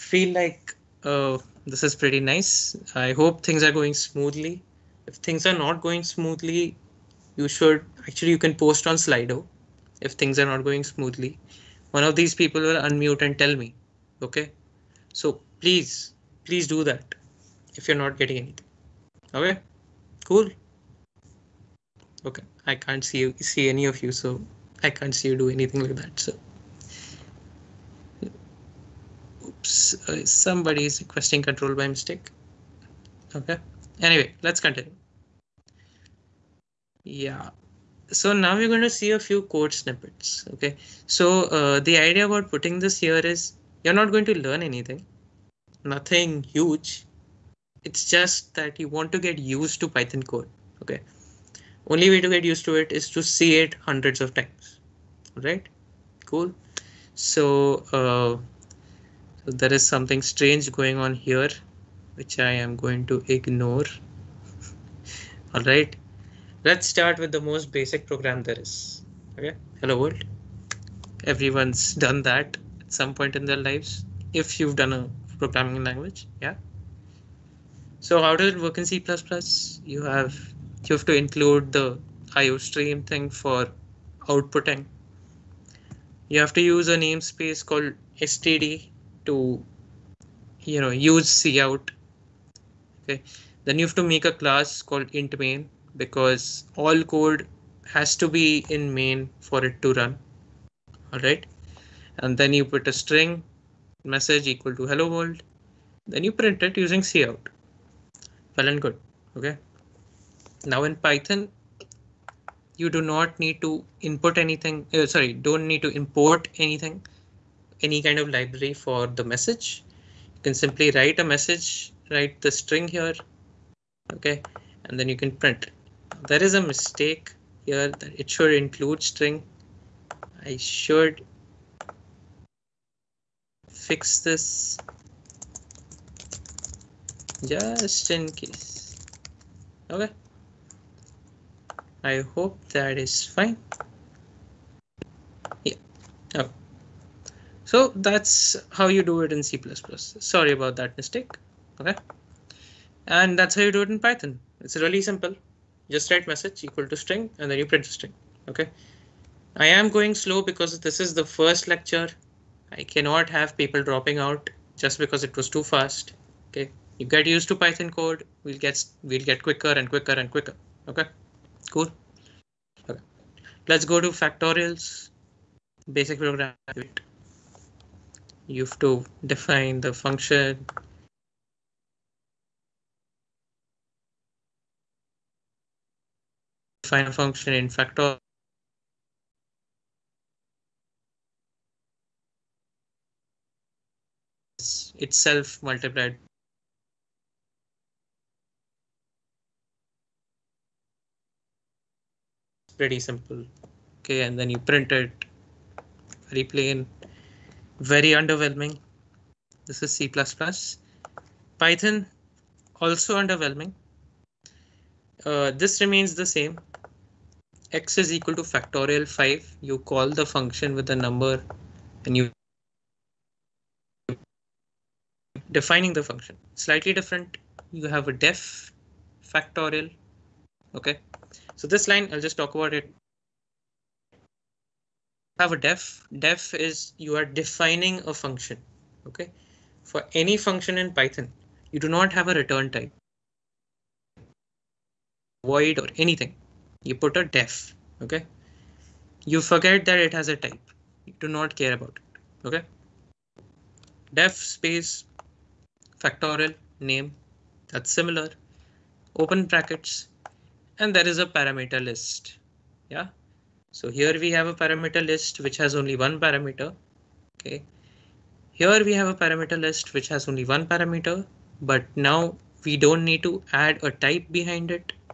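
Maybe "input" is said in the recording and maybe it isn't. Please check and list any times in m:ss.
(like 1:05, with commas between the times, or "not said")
1:54.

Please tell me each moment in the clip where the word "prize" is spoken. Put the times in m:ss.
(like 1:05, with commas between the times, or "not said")
not said.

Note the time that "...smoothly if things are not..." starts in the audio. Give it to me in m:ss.
0:03.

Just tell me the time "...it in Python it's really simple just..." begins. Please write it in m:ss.
2:33.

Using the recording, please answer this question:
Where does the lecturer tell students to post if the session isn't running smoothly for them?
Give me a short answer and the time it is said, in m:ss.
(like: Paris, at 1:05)
Slido, at 0:08.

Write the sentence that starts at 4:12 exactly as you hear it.
OK, def space factorial name that's similar open brackets and there is a parameter list.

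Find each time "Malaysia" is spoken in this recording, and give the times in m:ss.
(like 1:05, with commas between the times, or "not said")
not said.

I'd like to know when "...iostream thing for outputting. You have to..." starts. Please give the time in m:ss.
1:22.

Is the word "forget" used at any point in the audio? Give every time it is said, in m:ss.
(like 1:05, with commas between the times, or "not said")
4:09.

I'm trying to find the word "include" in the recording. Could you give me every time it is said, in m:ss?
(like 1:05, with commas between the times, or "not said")
1:21, 2:08.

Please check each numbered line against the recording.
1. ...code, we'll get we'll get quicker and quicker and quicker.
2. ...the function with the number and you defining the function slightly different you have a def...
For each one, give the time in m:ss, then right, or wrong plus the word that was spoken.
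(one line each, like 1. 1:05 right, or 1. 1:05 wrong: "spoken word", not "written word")
1. 2:47 right
2. 3:40 right.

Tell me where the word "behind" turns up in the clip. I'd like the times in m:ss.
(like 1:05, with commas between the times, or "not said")
4:34.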